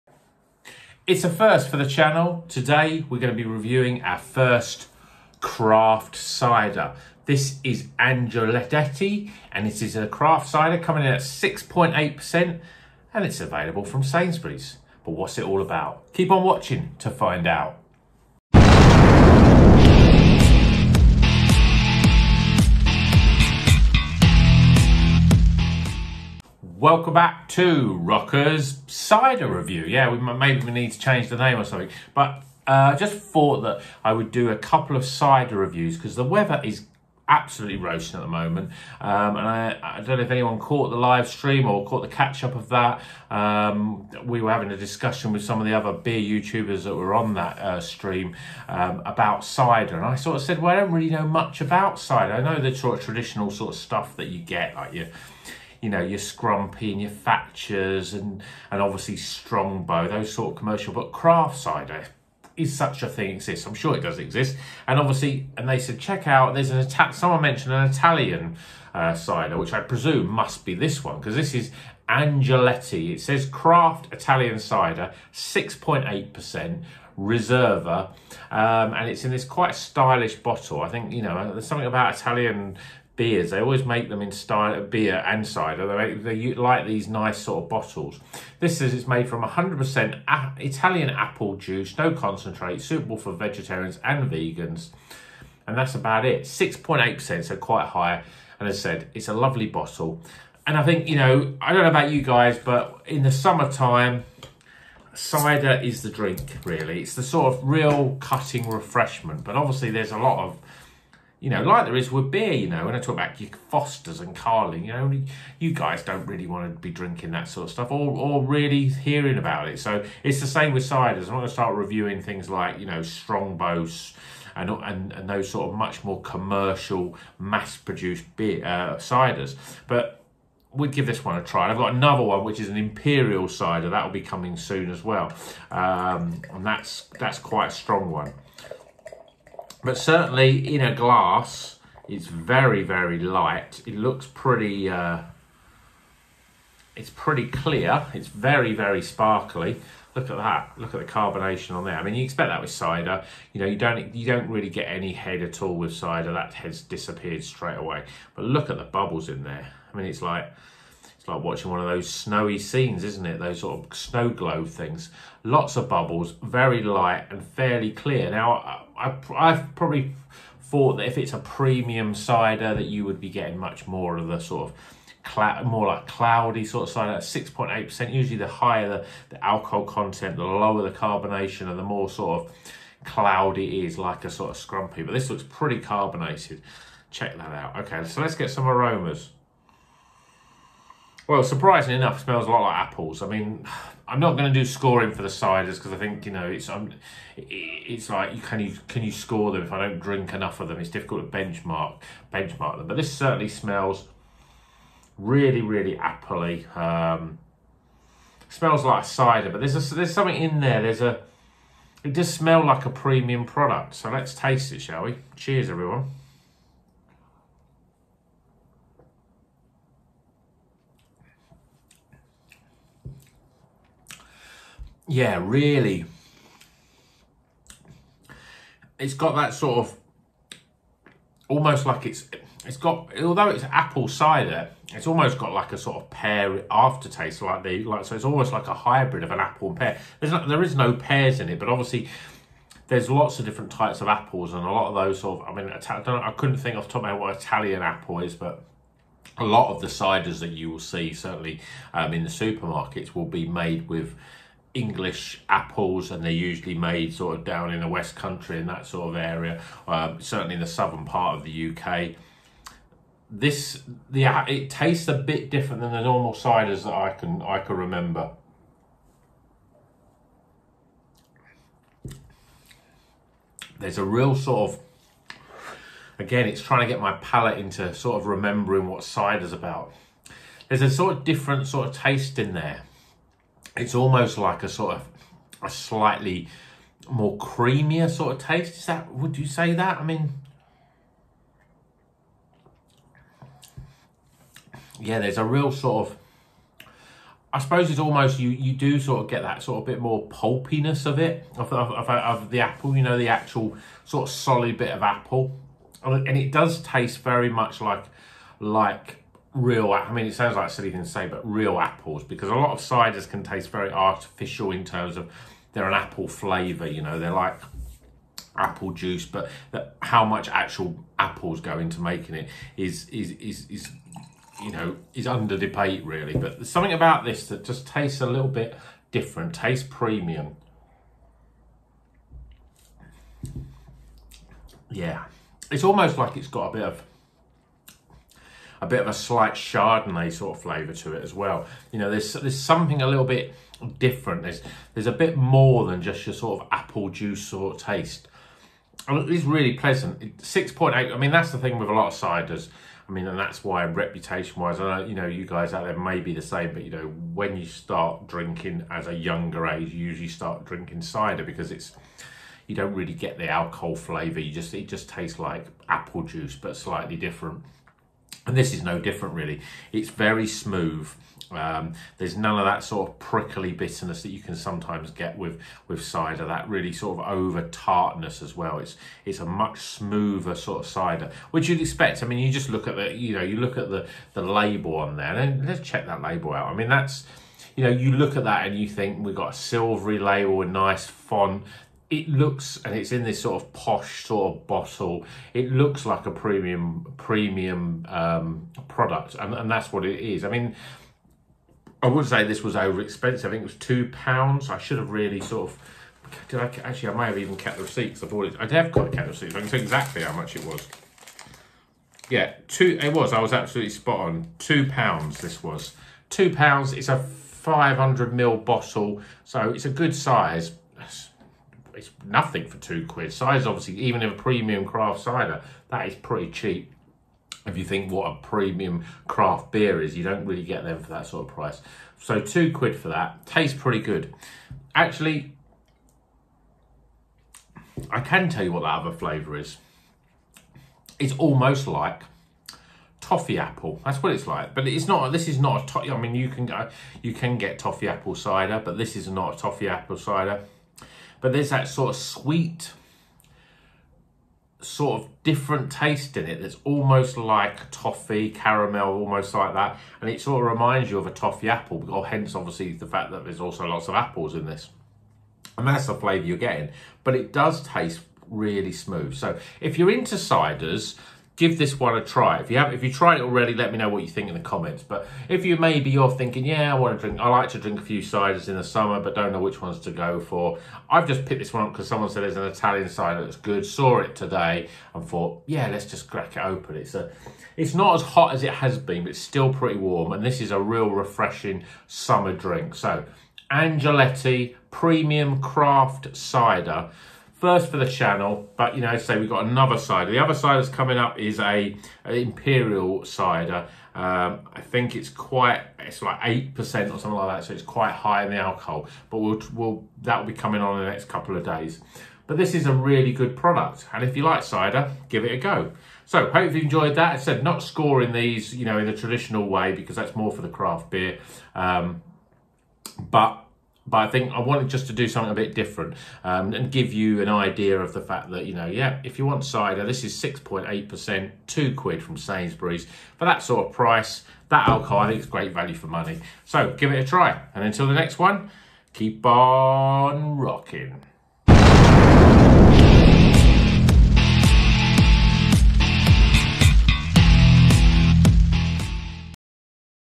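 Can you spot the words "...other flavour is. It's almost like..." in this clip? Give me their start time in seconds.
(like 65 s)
439 s.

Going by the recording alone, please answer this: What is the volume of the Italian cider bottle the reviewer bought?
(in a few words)
500 ml.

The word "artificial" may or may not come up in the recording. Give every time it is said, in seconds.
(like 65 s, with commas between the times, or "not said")
313 s.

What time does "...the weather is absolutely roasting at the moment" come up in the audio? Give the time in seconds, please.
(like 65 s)
36 s.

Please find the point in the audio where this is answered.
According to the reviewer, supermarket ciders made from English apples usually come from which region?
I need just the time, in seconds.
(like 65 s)
257 s.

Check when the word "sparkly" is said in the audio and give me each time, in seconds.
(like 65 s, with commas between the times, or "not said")
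149 s.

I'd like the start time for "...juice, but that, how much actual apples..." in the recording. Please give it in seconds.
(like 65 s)
318 s.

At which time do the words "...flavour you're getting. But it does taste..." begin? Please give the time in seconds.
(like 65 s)
466 s.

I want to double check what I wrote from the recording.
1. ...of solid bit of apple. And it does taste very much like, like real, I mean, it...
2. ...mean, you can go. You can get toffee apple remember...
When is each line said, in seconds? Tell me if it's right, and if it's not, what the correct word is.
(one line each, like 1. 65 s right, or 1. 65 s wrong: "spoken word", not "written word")
1. 304 s right
2. 446 s wrong: "cider", not "remember".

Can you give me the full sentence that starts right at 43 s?
Um, we were having a discussion with some of the other beer YouTubers that were on that uh, stream um, about cider.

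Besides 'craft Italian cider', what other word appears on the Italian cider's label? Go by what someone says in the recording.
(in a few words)
Reserva.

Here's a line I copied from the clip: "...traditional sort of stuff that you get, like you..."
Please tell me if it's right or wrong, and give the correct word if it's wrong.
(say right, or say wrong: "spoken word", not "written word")
right.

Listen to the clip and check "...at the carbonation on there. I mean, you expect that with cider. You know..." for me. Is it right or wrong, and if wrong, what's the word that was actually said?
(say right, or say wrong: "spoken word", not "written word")
right.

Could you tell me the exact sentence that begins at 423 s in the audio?
Cider's obviously, even in a premium craft cider, that is pretty cheap.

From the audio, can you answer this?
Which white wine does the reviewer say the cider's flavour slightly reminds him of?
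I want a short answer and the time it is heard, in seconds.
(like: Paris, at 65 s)
Chardonnay, at 339 s.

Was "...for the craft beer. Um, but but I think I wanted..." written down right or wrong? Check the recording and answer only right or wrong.
right.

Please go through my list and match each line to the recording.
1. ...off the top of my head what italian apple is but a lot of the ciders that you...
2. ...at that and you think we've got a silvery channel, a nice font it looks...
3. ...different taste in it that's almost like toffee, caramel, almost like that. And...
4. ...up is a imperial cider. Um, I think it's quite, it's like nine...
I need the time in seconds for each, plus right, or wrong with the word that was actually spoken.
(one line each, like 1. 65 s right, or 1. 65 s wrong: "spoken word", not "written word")
1. 246 s right
2. 388 s wrong: "label", not "channel"
3. 455 s right
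4. 501 s wrong: "eight", not "nine".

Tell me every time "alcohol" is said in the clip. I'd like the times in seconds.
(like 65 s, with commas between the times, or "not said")
179 s, 363 s, 508 s, 534 s.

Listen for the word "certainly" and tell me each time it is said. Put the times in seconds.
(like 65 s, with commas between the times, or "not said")
139 s, 203 s, 251 s, 260 s.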